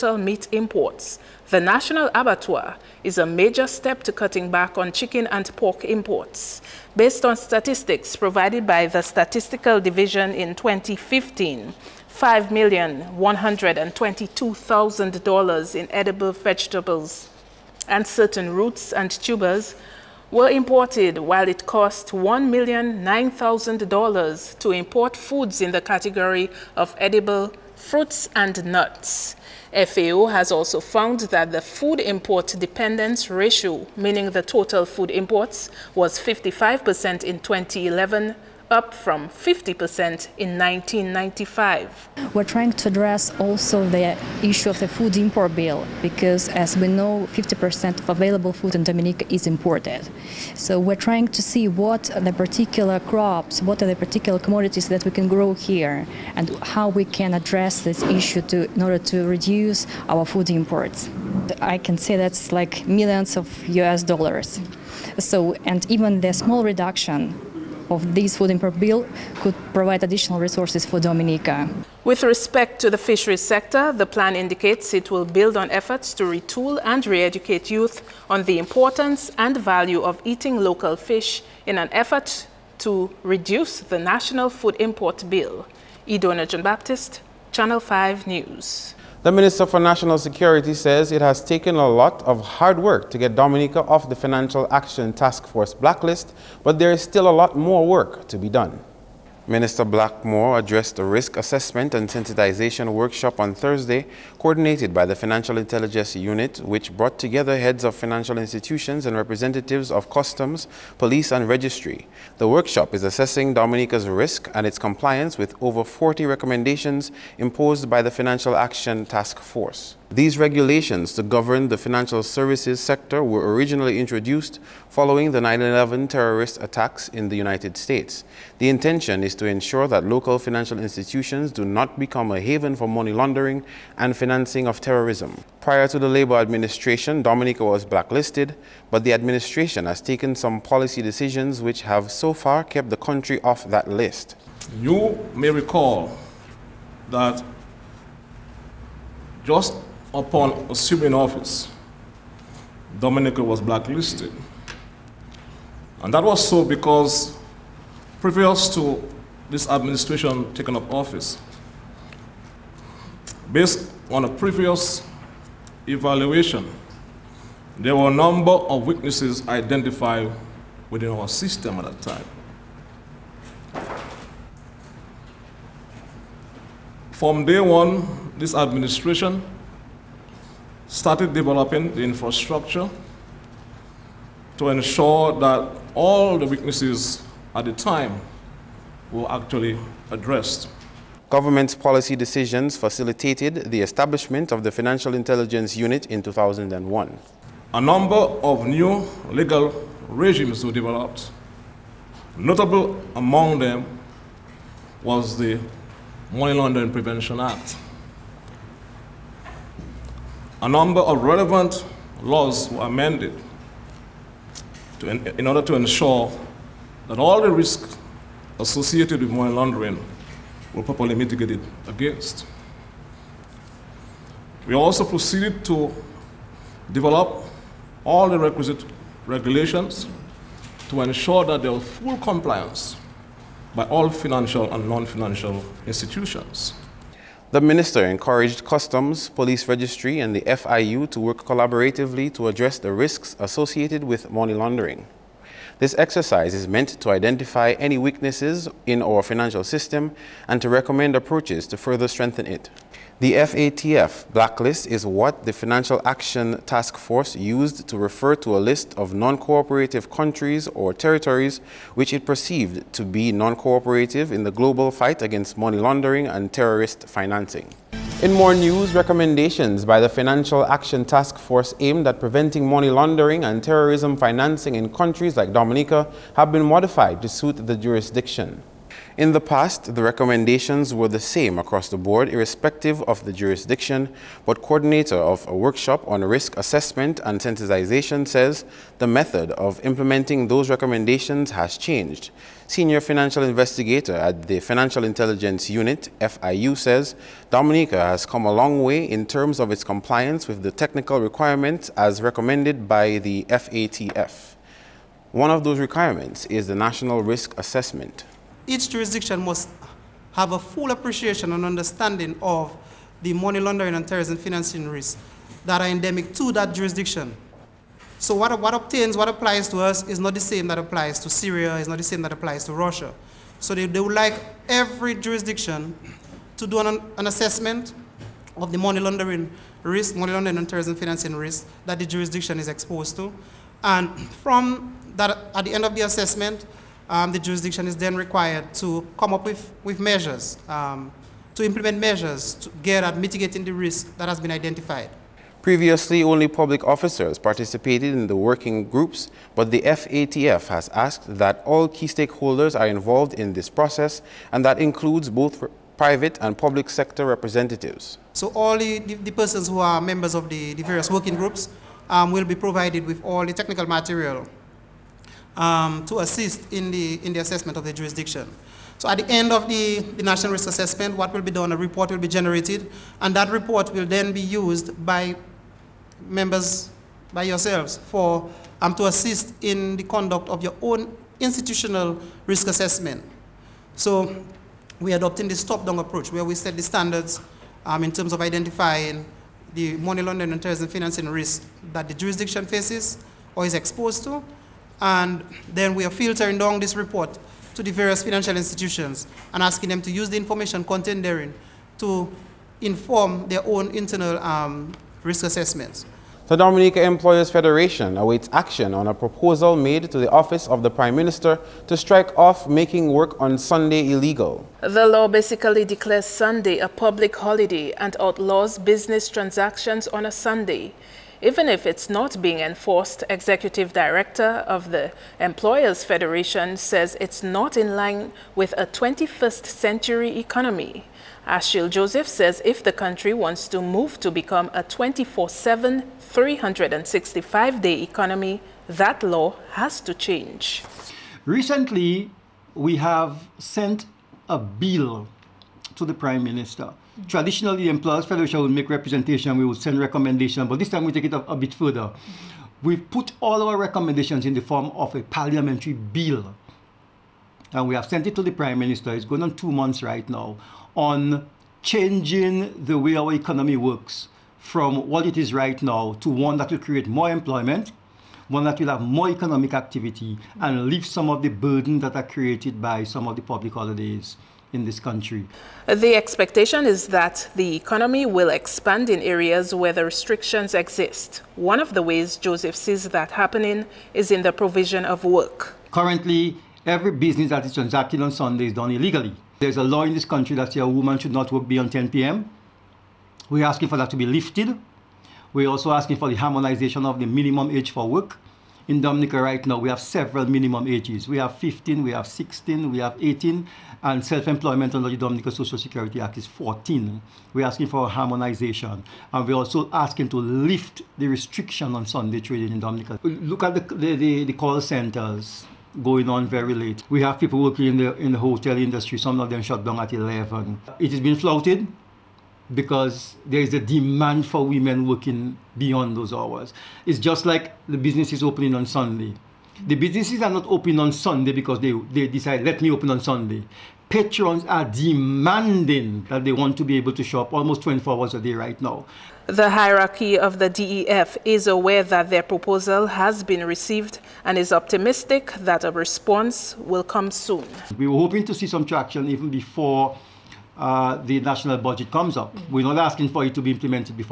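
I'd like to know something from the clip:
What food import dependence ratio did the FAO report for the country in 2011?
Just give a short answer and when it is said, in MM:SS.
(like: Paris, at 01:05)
55%, at 00:36.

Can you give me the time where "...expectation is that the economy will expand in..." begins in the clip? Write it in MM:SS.
07:56.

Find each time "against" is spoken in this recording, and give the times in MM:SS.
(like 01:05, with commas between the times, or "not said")
03:41, 04:25.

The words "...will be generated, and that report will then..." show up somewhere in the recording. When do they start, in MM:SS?
06:12.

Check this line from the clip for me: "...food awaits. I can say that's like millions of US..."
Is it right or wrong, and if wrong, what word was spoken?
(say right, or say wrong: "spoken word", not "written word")
wrong: "imports", not "awaits".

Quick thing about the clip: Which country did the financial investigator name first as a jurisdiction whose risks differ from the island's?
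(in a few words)
Syria.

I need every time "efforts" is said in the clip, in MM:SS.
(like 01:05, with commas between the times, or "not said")
01:15, 01:21.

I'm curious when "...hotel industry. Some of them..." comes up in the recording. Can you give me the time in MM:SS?
08:38.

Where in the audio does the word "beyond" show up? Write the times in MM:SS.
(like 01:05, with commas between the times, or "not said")
08:11, 08:45.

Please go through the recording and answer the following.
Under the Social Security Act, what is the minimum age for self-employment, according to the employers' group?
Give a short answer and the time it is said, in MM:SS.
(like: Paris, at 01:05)
14, at 08:26.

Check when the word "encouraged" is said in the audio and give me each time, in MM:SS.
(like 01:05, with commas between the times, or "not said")
03:58.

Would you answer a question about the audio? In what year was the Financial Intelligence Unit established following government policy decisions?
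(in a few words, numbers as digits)
2001.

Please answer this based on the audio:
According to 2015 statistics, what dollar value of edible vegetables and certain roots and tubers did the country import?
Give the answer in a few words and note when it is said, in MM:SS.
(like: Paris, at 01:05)
$5,122,000, at 00:12.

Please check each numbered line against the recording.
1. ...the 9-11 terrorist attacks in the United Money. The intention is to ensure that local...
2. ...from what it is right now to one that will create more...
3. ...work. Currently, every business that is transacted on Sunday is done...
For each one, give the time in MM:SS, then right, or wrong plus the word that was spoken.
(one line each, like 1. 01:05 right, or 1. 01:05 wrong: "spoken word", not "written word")
1. 02:05 wrong: "States", not "Money"
2. 07:44 right
3. 08:05 right.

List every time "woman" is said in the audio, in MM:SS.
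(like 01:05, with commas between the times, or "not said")
08:10.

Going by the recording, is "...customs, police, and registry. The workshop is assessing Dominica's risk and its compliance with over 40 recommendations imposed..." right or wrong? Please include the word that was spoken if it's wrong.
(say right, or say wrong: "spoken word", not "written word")
right.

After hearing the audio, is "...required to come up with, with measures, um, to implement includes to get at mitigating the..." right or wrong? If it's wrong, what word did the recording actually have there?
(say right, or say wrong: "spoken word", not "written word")
wrong: "measures", not "includes".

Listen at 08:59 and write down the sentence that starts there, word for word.
The hierarchy of the DEF is aware that their proposal has been received and is optimistic that a response will come soon.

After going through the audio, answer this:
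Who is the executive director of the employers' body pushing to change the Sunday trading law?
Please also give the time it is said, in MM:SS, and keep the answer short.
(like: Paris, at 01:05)
Ashil Joseph, at 07:11.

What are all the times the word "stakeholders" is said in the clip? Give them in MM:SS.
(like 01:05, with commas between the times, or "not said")
05:52.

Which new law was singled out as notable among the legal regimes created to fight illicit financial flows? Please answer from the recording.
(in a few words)
Money Laundering Prevention Act.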